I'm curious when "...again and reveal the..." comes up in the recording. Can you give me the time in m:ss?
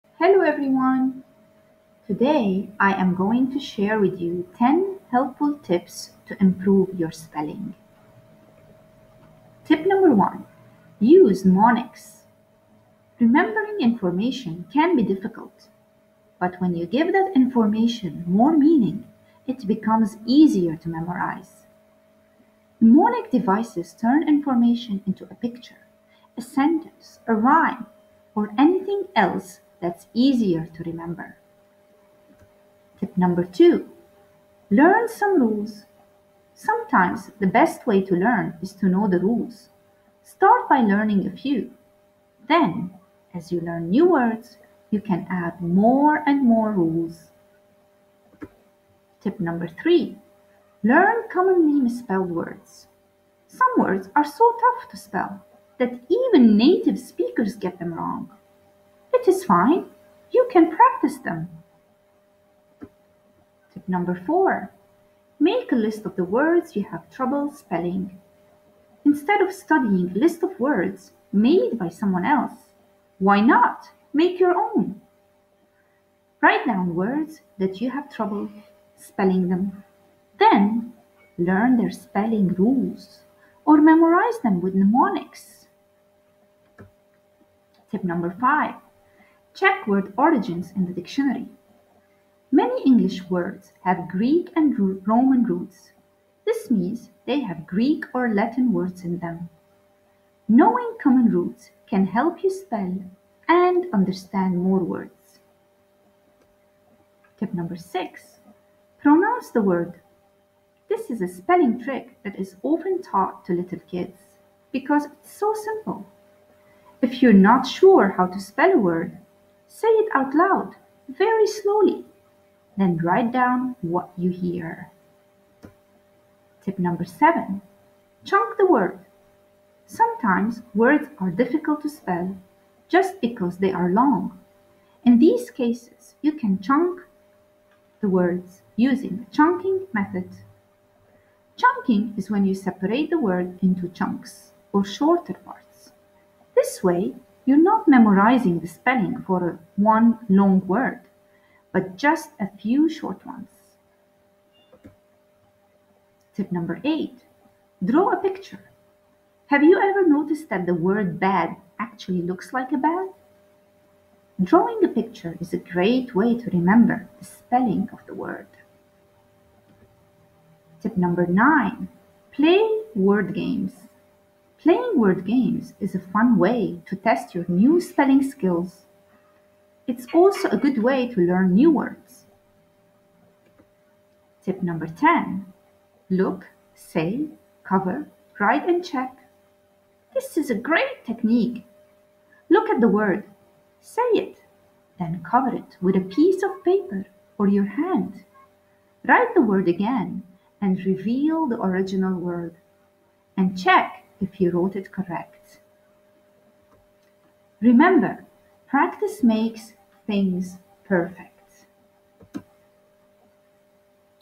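3:19.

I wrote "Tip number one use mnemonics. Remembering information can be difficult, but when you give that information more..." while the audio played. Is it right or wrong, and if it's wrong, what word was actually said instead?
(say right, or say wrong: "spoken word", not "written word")
right.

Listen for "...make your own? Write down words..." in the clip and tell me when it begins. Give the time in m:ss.
1:14.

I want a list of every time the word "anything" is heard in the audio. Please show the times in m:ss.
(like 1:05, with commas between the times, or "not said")
0:28.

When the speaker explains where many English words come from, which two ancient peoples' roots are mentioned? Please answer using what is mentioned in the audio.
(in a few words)
Greek and Roman.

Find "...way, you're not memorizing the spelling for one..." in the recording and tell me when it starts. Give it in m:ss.
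2:26.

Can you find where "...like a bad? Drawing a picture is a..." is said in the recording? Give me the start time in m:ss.
2:42.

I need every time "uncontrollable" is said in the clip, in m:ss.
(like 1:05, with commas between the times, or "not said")
not said.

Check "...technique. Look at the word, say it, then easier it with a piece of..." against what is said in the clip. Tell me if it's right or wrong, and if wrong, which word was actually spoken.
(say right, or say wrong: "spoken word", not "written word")
wrong: "cover", not "easier".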